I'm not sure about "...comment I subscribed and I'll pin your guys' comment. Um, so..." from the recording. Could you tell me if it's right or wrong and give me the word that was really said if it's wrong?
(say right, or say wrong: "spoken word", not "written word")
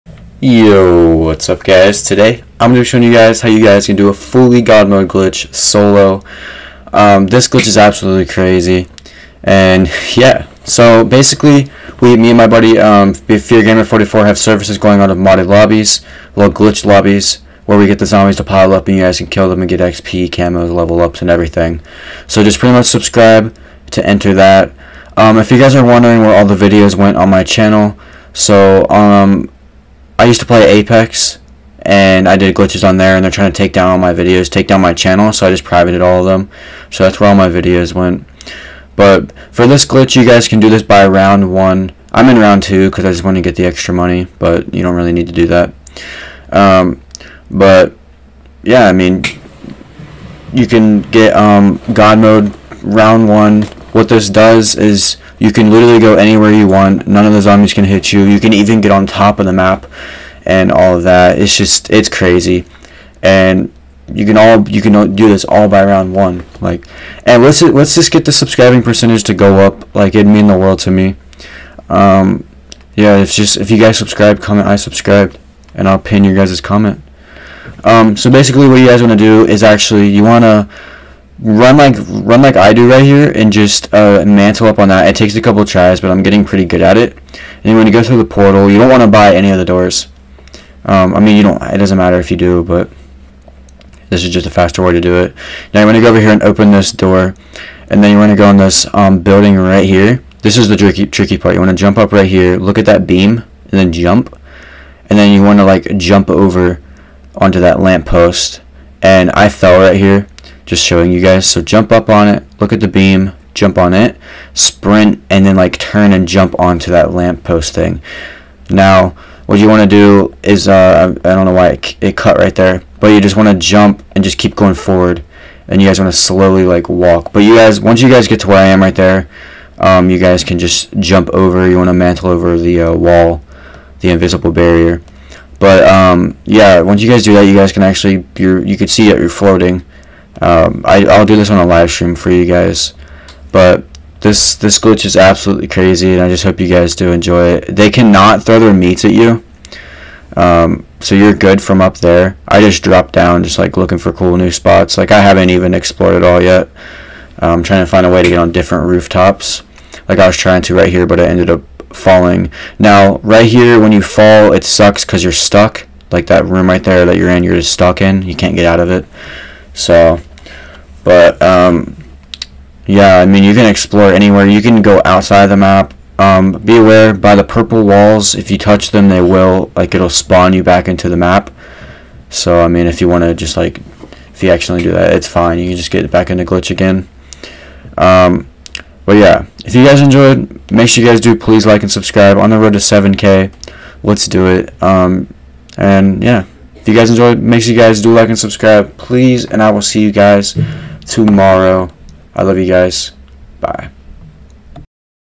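right.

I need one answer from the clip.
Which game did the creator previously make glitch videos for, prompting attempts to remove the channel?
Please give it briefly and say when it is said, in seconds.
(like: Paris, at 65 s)
Apex, at 30 s.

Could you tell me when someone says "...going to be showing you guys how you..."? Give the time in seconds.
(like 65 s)
2 s.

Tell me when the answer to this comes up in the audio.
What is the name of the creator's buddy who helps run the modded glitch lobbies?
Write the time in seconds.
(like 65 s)
13 s.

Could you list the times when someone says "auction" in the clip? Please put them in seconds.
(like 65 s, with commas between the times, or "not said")
not said.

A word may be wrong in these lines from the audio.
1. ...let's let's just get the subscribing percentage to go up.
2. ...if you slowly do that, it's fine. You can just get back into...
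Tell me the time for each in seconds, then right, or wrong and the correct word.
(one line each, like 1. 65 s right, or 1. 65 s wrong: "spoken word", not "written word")
1. 67 s right
2. 184 s wrong: "accidentally", not "slowly".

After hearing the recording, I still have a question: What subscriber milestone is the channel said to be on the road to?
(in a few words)
7K.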